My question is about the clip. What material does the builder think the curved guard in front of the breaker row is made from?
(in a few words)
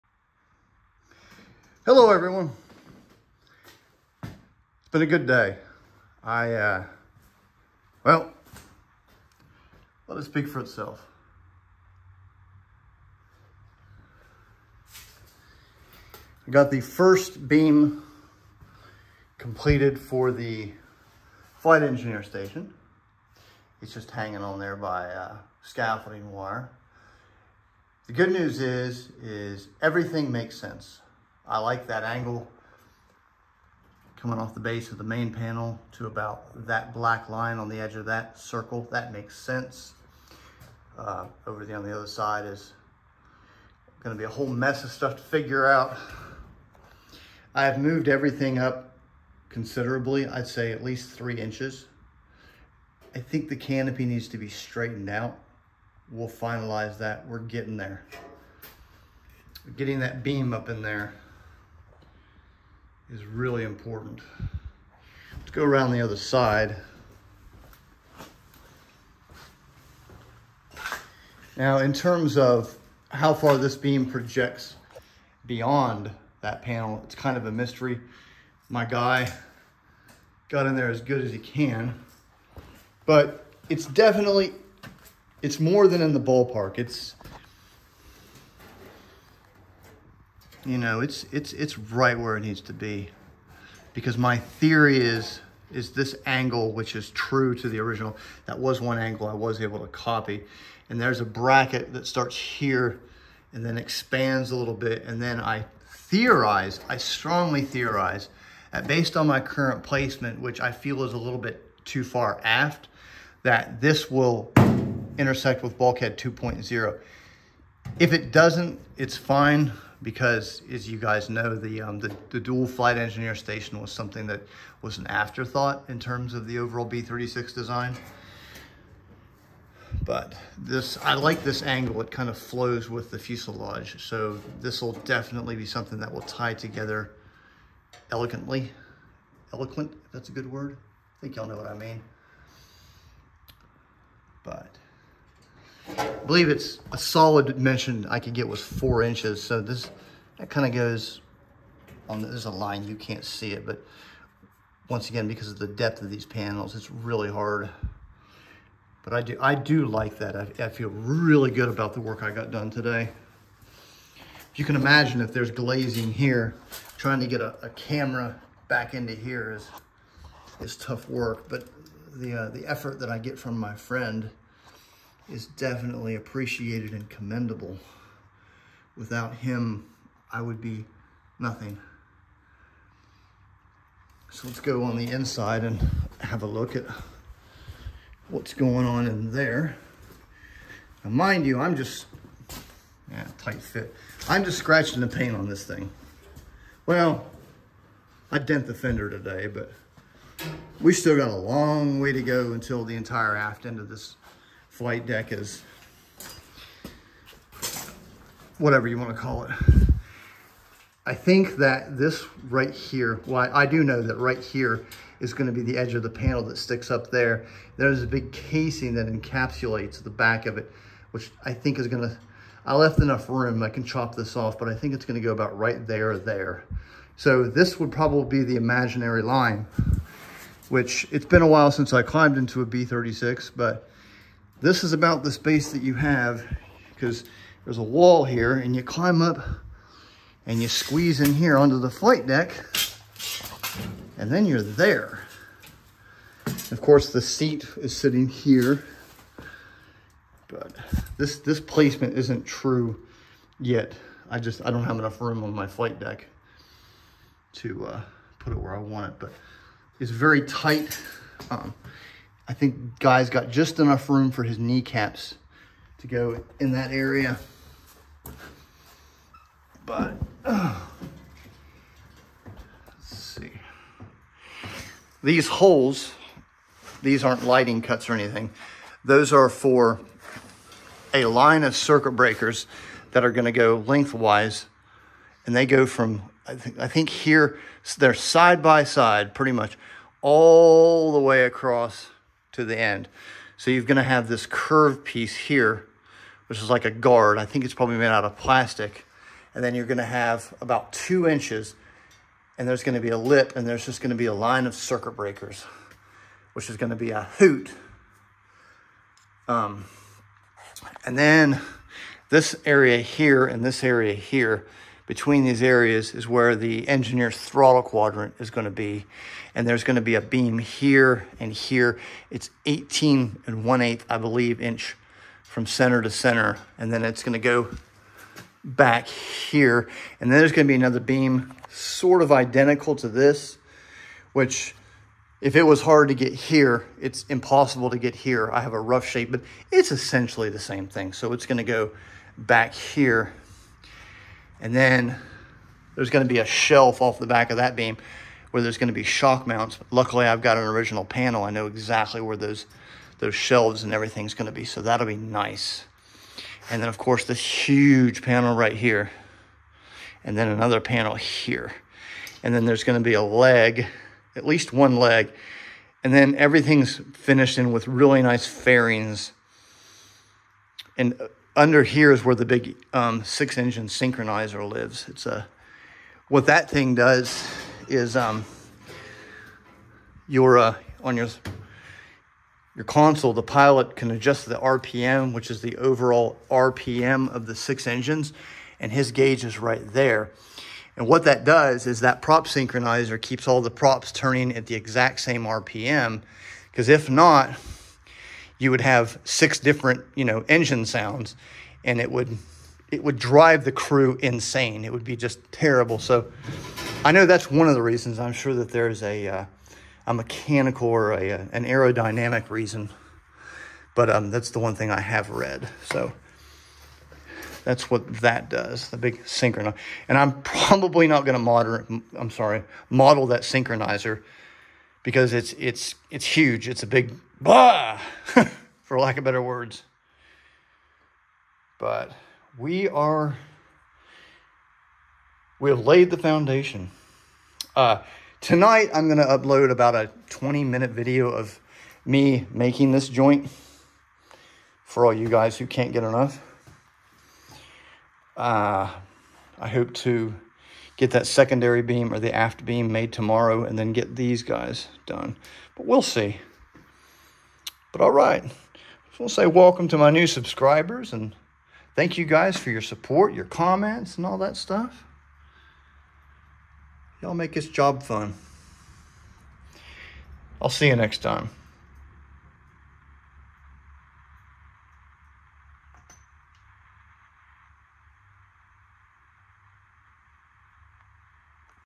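plastic.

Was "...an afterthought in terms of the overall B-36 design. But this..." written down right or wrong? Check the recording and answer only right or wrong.
right.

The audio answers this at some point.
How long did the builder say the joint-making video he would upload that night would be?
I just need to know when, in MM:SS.
07:20.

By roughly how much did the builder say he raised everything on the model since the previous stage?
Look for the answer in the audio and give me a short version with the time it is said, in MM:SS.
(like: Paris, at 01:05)
3 inches, at 00:51.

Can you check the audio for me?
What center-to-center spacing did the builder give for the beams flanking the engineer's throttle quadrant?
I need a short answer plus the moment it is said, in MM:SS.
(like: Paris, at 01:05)
18 1/8 inches, at 05:22.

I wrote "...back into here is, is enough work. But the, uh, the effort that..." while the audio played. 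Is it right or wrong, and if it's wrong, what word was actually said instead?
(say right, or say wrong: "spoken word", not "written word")
wrong: "tough", not "enough".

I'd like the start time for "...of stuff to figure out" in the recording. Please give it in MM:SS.
00:44.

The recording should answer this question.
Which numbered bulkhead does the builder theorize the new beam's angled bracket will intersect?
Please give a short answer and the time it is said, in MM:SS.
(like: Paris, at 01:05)
bulkhead 2.0, at 01:55.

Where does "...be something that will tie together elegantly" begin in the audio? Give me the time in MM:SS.
02:15.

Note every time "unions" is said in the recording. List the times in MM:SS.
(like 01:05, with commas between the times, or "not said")
not said.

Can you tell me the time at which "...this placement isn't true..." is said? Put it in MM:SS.
04:11.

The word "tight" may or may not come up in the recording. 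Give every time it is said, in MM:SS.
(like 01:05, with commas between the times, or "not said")
03:13, 04:20.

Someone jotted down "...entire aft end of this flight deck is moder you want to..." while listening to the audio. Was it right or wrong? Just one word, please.
wrong.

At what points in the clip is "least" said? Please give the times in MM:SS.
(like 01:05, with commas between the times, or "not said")
00:50, 06:04.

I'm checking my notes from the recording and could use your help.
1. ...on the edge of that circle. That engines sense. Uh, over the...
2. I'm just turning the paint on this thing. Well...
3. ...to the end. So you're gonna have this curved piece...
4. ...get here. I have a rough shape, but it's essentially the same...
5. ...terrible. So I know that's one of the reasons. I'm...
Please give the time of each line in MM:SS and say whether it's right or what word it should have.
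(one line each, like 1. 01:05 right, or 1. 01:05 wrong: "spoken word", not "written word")
1. 00:37 wrong: "makes", not "engines"
2. 03:14 wrong: "scratching", not "turning"
3. 04:52 right
4. 05:37 right
5. 06:45 right.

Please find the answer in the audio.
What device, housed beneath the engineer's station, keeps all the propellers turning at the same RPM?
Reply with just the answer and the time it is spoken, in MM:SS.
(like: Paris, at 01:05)
six engine synchronizer, at 06:13.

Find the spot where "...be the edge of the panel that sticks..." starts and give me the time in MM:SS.
03:35.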